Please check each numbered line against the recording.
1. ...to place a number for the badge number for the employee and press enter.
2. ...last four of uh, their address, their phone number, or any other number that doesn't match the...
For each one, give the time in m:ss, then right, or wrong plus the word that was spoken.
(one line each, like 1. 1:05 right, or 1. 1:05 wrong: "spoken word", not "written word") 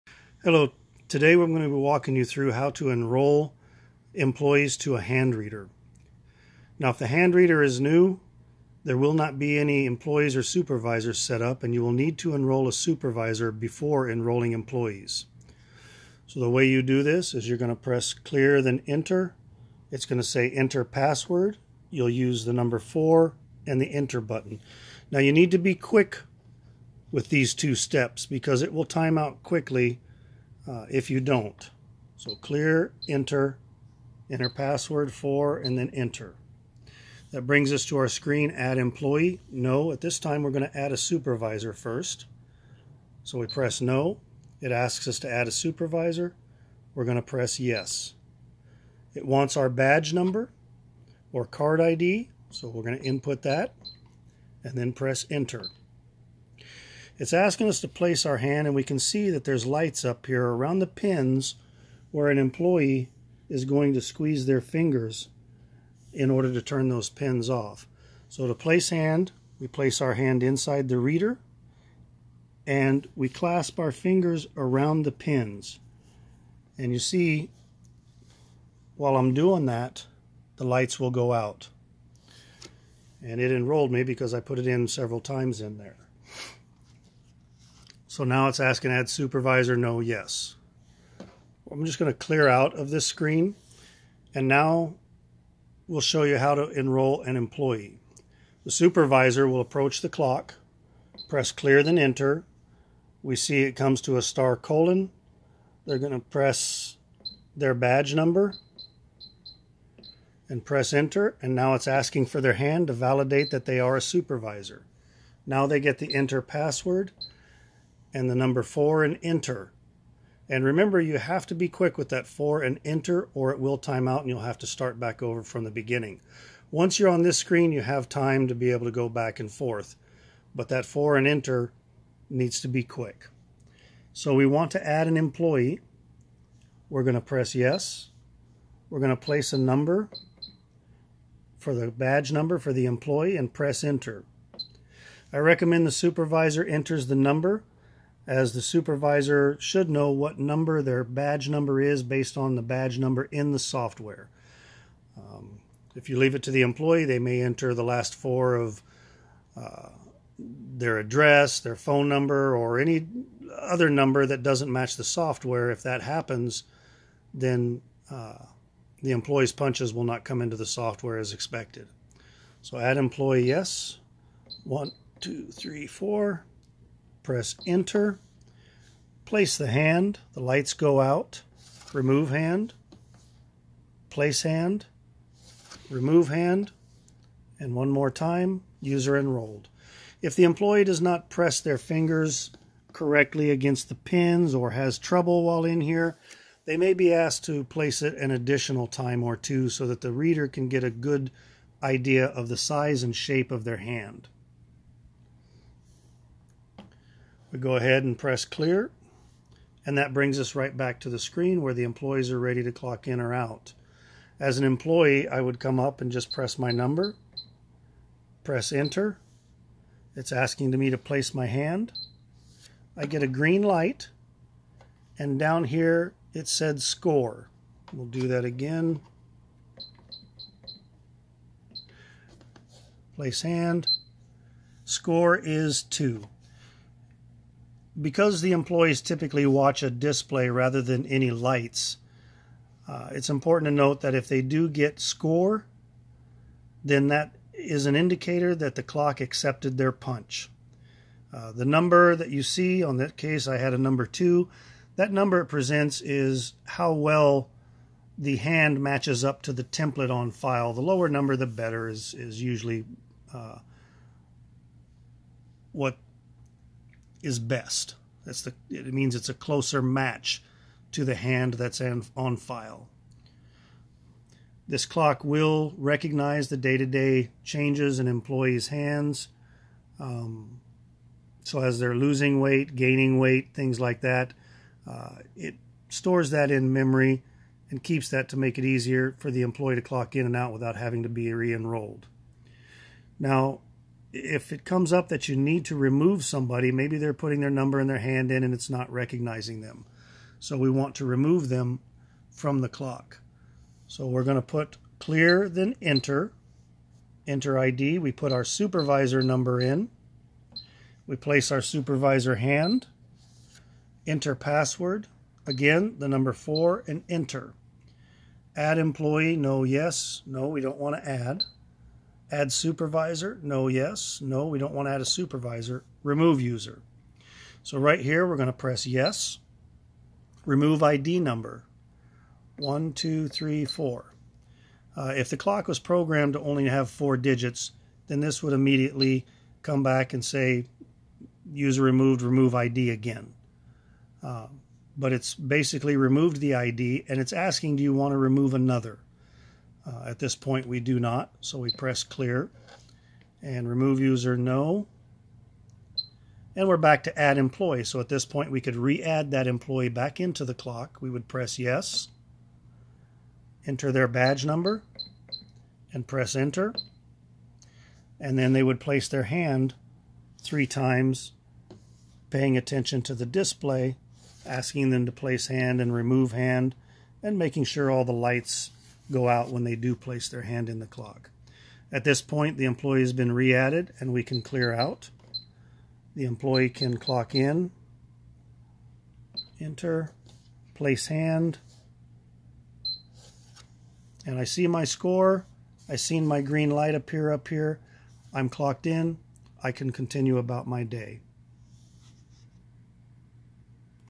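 1. 2:19 right
2. 2:37 right.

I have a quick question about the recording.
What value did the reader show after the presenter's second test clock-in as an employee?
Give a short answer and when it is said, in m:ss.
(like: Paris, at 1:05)
2, at 3:54.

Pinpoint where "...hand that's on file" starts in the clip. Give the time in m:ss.
4:31.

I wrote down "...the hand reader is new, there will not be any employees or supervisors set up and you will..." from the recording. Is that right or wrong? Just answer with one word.
right.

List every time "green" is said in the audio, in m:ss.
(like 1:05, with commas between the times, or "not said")
3:43, 6:36.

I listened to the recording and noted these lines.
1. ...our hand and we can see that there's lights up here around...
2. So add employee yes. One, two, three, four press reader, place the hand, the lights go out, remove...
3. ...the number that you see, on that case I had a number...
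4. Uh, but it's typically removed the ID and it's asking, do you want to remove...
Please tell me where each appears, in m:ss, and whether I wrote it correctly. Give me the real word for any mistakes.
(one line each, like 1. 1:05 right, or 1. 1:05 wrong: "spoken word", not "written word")
1. 0:58 right
2. 2:52 wrong: "enter", not "reader"
3. 4:11 right
4. 5:44 wrong: "basically", not "typically".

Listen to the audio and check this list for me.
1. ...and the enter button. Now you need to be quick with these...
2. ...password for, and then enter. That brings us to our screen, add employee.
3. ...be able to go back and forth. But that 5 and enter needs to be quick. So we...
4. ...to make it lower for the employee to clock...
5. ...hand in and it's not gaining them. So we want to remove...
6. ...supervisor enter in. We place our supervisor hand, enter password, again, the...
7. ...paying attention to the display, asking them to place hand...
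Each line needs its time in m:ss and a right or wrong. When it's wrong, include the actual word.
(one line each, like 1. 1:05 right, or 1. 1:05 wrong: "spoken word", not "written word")
1. 0:23 right
2. 0:34 right
3. 2:08 wrong: "4", not "5"
4. 4:48 wrong: "easier", not "lower"
5. 4:57 wrong: "recognizing", not "gaining"
6. 5:08 wrong: "number", not "enter"
7. 6:12 right.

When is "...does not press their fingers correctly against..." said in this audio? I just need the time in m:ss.
3:10.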